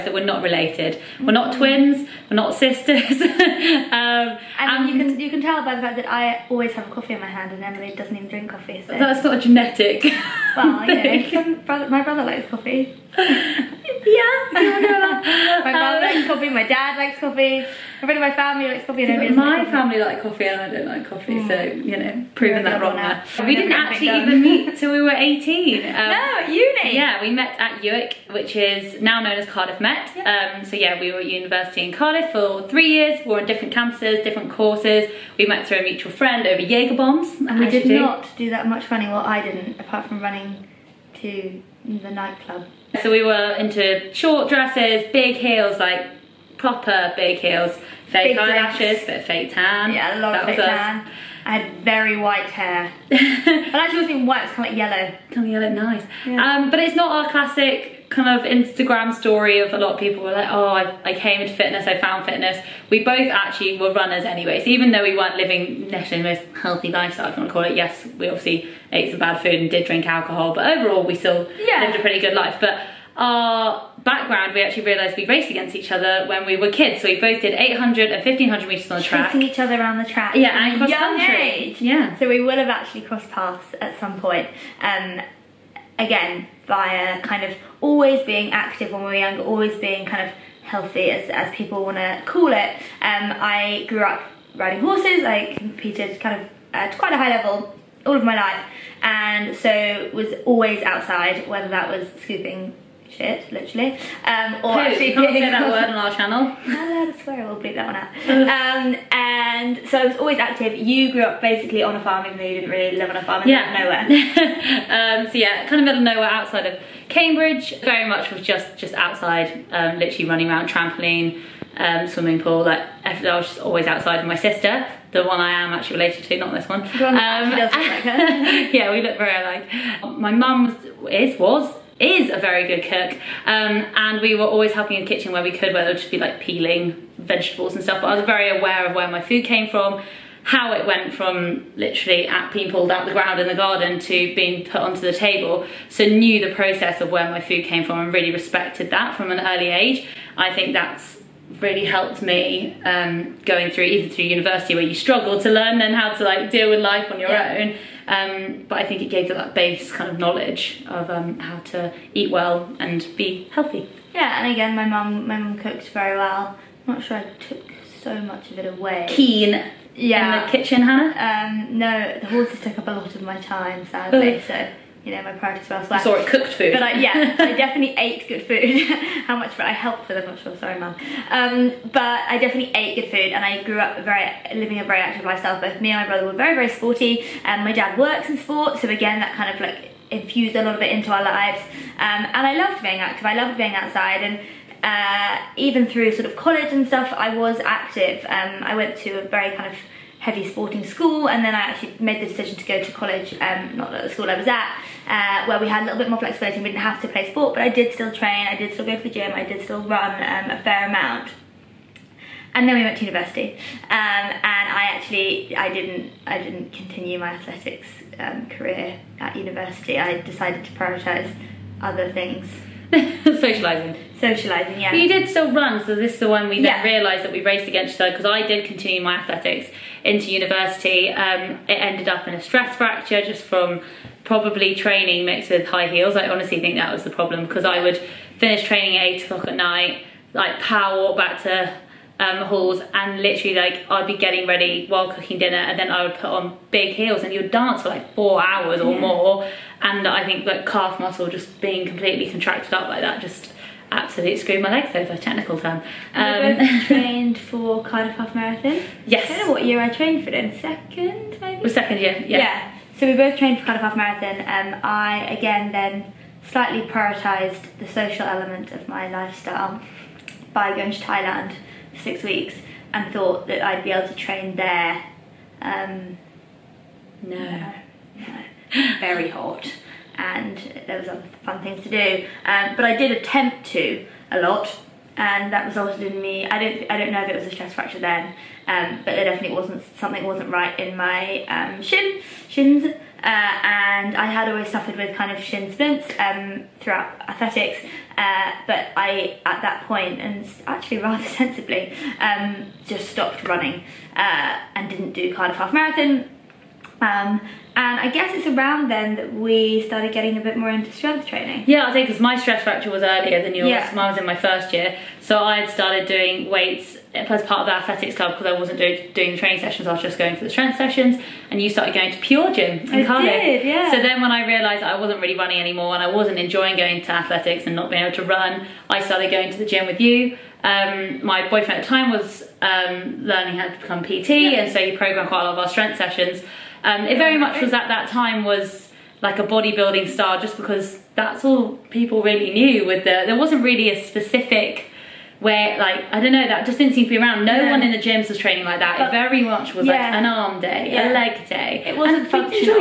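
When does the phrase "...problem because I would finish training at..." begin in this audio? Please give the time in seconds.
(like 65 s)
237 s.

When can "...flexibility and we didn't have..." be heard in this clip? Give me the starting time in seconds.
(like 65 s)
206 s.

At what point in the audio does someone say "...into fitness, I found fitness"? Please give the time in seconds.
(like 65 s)
61 s.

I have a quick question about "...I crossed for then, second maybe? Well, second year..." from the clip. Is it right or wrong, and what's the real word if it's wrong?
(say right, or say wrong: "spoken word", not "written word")
wrong: "trained", not "crossed".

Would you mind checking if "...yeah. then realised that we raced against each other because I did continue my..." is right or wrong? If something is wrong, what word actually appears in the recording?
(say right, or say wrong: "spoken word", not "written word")
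right.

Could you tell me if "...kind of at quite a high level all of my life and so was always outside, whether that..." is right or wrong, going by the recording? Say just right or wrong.
right.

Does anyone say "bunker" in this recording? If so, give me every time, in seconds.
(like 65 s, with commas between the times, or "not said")
not said.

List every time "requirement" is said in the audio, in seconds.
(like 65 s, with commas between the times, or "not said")
not said.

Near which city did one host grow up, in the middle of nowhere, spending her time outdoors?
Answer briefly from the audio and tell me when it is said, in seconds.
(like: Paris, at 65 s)
Cambridge, at 117 s.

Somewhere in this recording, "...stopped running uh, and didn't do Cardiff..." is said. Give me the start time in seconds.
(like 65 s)
303 s.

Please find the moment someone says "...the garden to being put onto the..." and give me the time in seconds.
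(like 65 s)
143 s.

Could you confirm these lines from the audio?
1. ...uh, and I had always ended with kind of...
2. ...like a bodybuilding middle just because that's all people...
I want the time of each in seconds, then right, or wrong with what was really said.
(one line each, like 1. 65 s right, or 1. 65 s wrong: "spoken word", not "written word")
1. 292 s wrong: "suffered", not "ended"
2. 339 s wrong: "style", not "middle".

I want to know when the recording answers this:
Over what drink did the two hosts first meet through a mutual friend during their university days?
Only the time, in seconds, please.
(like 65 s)
36 s.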